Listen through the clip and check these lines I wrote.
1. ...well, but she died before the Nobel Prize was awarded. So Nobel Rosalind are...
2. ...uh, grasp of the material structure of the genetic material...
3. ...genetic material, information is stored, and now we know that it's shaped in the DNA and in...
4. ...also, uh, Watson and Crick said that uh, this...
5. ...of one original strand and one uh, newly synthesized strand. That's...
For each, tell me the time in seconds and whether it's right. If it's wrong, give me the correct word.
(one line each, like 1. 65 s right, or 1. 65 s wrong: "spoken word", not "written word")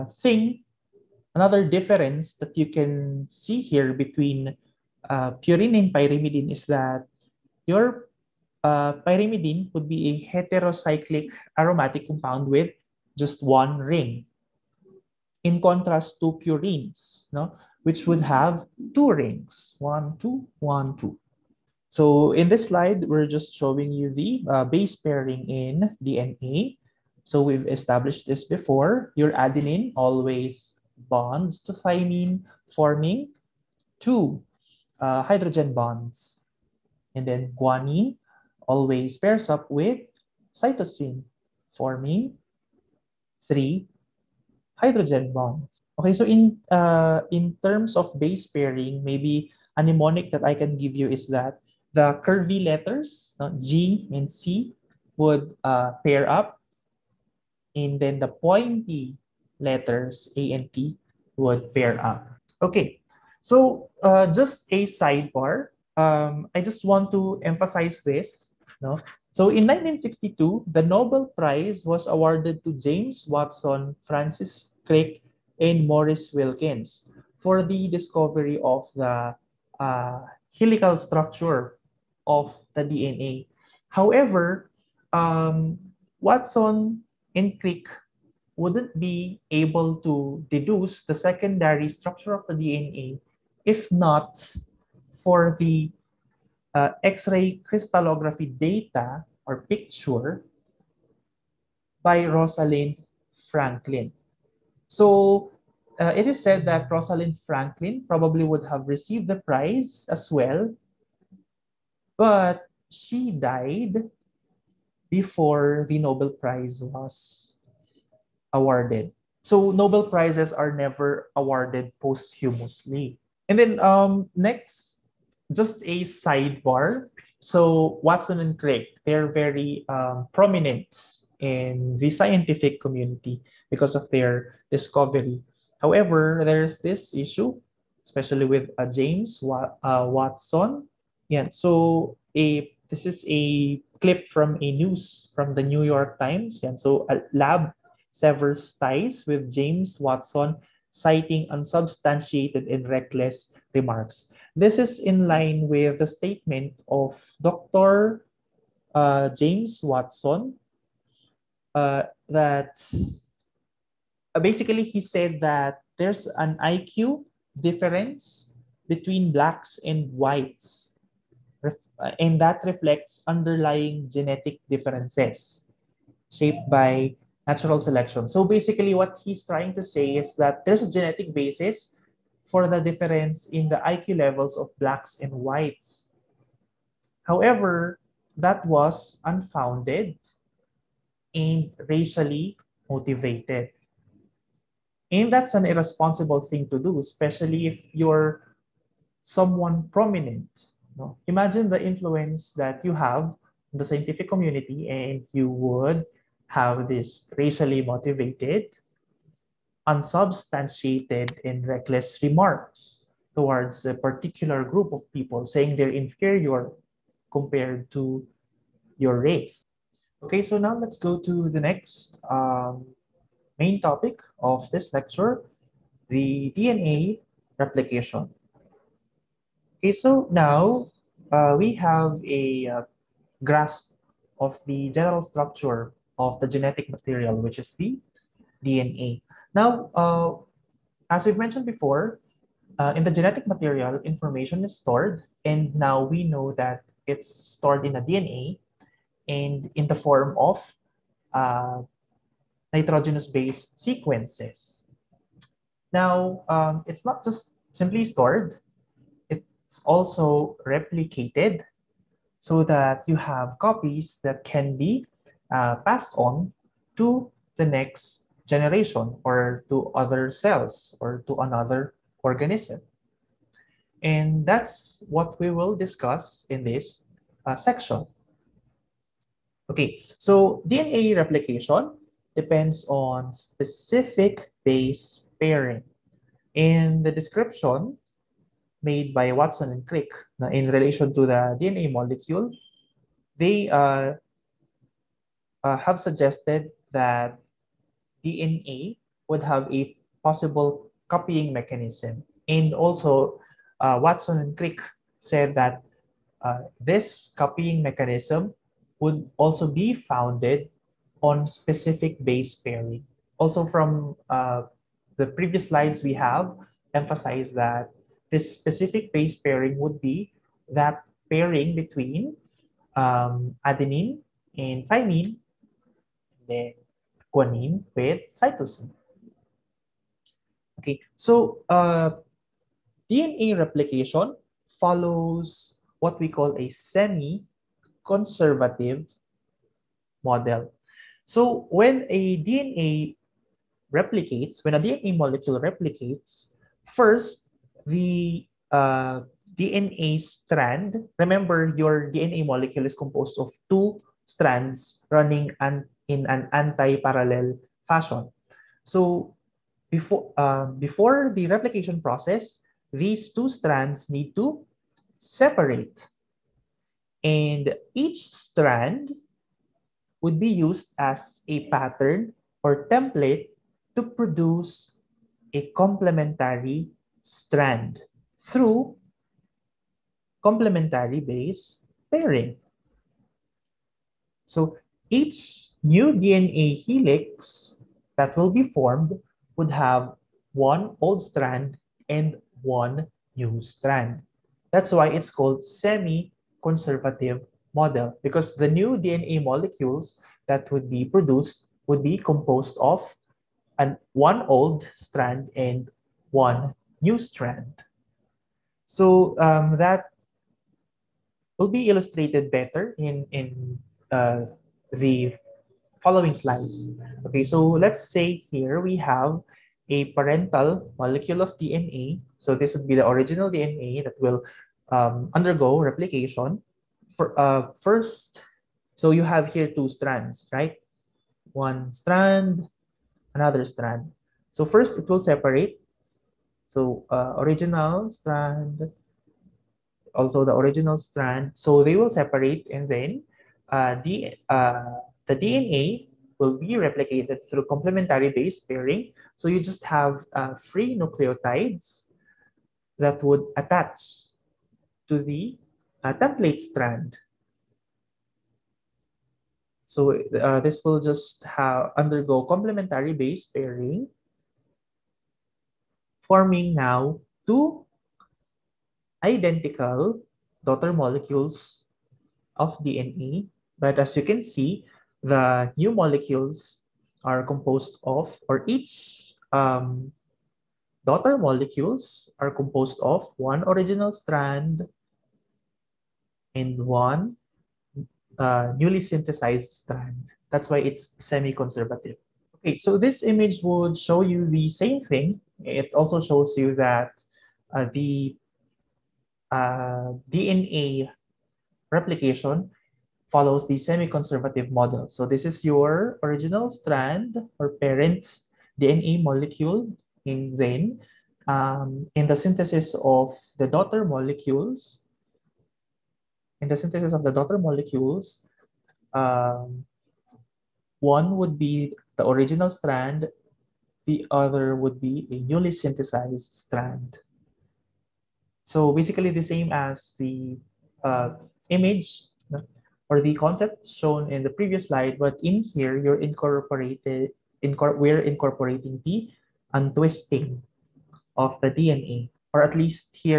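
1. 110 s wrong: "Prizes", not "Rosalind"
2. 232 s wrong: "general", not "material"
3. 243 s wrong: "stored", not "shaped"
4. 302 s right
5. 483 s right.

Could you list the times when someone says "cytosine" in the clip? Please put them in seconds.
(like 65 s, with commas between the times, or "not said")
40 s, 328 s.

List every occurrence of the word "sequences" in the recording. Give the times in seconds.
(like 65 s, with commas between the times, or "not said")
253 s.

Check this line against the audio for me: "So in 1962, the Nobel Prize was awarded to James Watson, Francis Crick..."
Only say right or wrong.
right.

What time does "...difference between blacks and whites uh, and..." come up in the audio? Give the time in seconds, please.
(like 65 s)
167 s.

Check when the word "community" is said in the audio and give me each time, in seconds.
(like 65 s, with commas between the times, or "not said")
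132 s, 204 s.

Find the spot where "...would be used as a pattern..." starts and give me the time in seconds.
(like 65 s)
370 s.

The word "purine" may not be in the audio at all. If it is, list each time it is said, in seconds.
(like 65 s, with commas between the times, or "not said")
5 s, 16 s.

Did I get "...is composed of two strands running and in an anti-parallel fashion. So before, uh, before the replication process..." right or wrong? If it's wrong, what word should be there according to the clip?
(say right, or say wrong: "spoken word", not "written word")
right.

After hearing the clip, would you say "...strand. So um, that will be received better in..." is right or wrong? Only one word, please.
wrong.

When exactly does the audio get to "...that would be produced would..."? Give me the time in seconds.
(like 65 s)
400 s.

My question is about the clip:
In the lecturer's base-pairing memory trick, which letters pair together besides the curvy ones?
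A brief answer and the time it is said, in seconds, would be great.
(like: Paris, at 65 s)
pointy letters, at 58 s.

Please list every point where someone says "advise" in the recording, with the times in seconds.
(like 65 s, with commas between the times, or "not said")
not said.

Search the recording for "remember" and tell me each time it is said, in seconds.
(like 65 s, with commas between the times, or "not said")
351 s.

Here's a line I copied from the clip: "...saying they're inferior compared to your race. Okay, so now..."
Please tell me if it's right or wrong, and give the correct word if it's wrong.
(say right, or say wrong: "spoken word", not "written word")
right.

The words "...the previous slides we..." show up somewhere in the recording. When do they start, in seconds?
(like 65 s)
315 s.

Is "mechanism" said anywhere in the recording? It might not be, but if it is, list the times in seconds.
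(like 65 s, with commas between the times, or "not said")
301 s, 307 s.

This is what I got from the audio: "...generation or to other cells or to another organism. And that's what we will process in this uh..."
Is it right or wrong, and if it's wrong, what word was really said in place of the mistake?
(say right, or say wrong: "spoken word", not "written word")
wrong: "discuss", not "process".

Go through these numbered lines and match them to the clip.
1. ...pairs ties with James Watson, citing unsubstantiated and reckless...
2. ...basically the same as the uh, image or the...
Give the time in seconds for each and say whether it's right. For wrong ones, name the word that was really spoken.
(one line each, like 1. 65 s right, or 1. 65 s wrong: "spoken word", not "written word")
1. 148 s wrong: "severs", not "pairs"
2. 528 s right.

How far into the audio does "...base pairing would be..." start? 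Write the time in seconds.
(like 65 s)
319 s.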